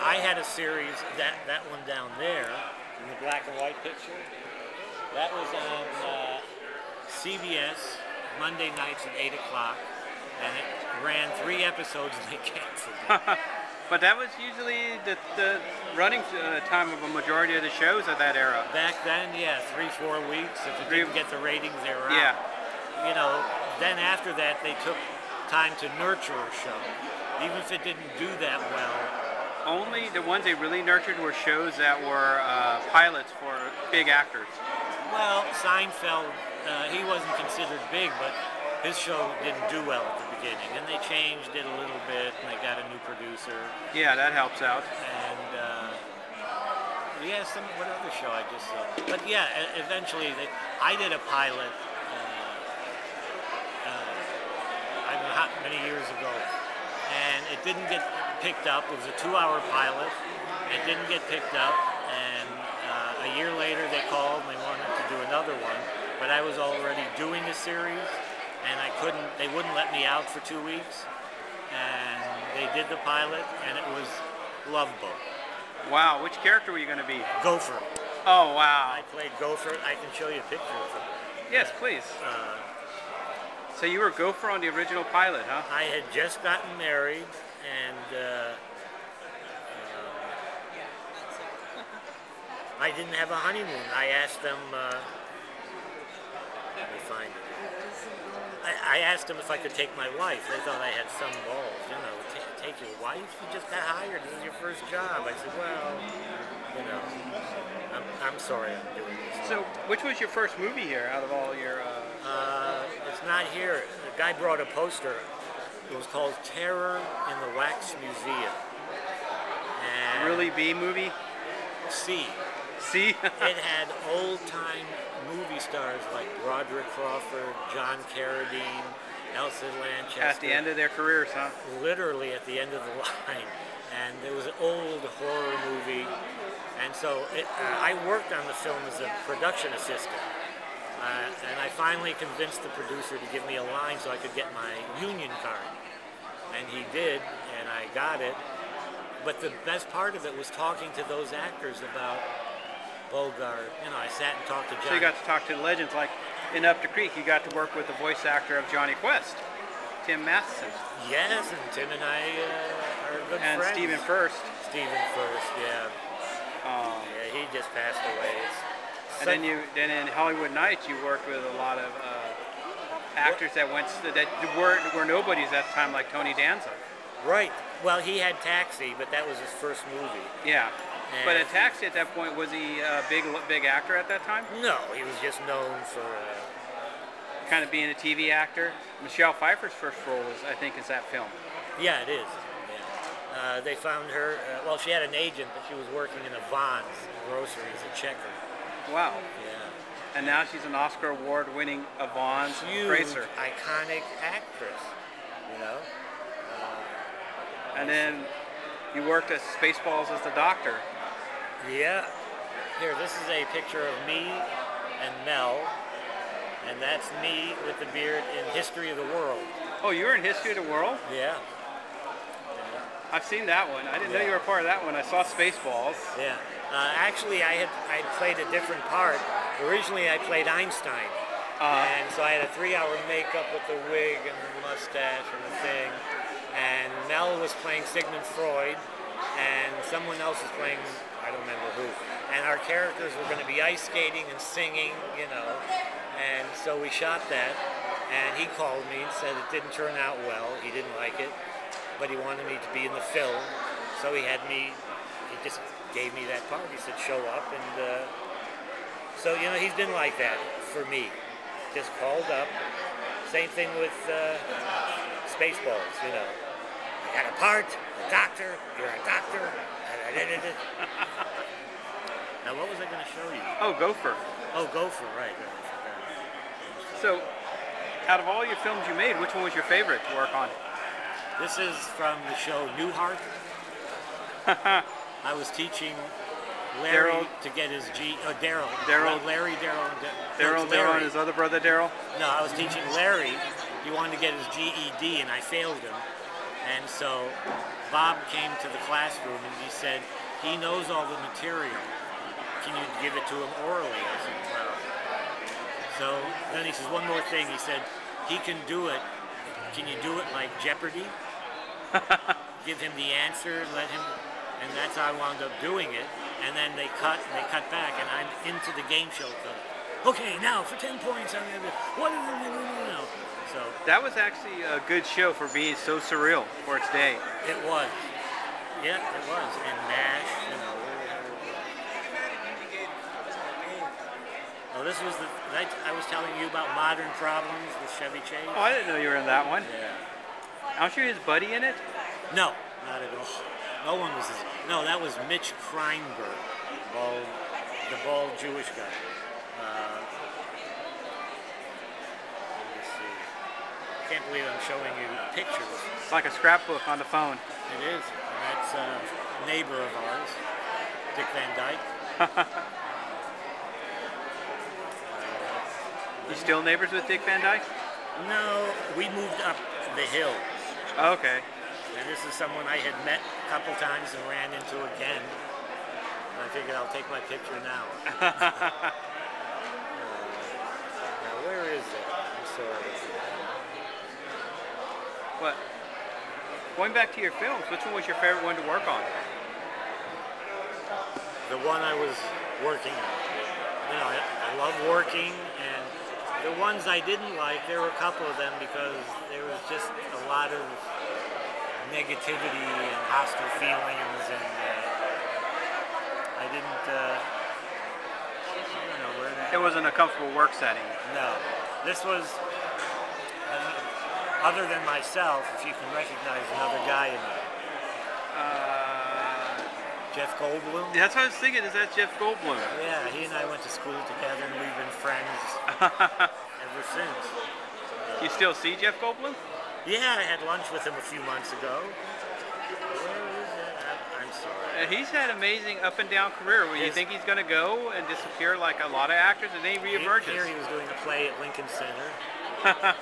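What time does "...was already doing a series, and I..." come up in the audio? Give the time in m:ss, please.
1:06.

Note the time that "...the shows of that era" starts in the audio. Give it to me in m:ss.
0:17.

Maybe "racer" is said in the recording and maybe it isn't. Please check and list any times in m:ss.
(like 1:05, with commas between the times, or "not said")
3:22.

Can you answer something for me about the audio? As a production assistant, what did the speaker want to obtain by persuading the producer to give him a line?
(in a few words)
union card.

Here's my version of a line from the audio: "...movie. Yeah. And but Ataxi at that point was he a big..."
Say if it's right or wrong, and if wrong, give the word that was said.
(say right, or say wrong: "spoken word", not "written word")
right.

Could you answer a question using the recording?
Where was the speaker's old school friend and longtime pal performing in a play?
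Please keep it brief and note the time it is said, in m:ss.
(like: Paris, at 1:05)
Lincoln Center, at 7:21.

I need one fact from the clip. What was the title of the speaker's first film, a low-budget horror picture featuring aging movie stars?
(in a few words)
Terror in the Wax Museum.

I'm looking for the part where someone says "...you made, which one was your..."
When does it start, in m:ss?
4:38.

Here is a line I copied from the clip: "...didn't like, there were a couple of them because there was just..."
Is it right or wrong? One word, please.
right.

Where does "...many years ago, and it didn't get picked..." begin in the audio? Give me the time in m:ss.
0:55.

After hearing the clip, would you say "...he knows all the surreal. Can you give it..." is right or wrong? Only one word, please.
wrong.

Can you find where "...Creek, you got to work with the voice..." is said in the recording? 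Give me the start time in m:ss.
2:36.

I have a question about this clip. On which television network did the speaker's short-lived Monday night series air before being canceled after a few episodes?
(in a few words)
CBS.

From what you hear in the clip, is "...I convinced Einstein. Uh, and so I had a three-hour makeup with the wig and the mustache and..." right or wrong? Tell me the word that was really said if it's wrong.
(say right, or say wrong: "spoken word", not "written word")
wrong: "played", not "convinced".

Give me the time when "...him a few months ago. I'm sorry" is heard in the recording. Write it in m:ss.
7:10.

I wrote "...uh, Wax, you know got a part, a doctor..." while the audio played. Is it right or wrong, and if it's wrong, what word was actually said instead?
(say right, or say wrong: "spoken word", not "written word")
wrong: "Spaceballs", not "Wax".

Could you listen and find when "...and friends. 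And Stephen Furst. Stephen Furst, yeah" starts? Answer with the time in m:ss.
2:43.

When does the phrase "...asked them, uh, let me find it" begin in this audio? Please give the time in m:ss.
1:34.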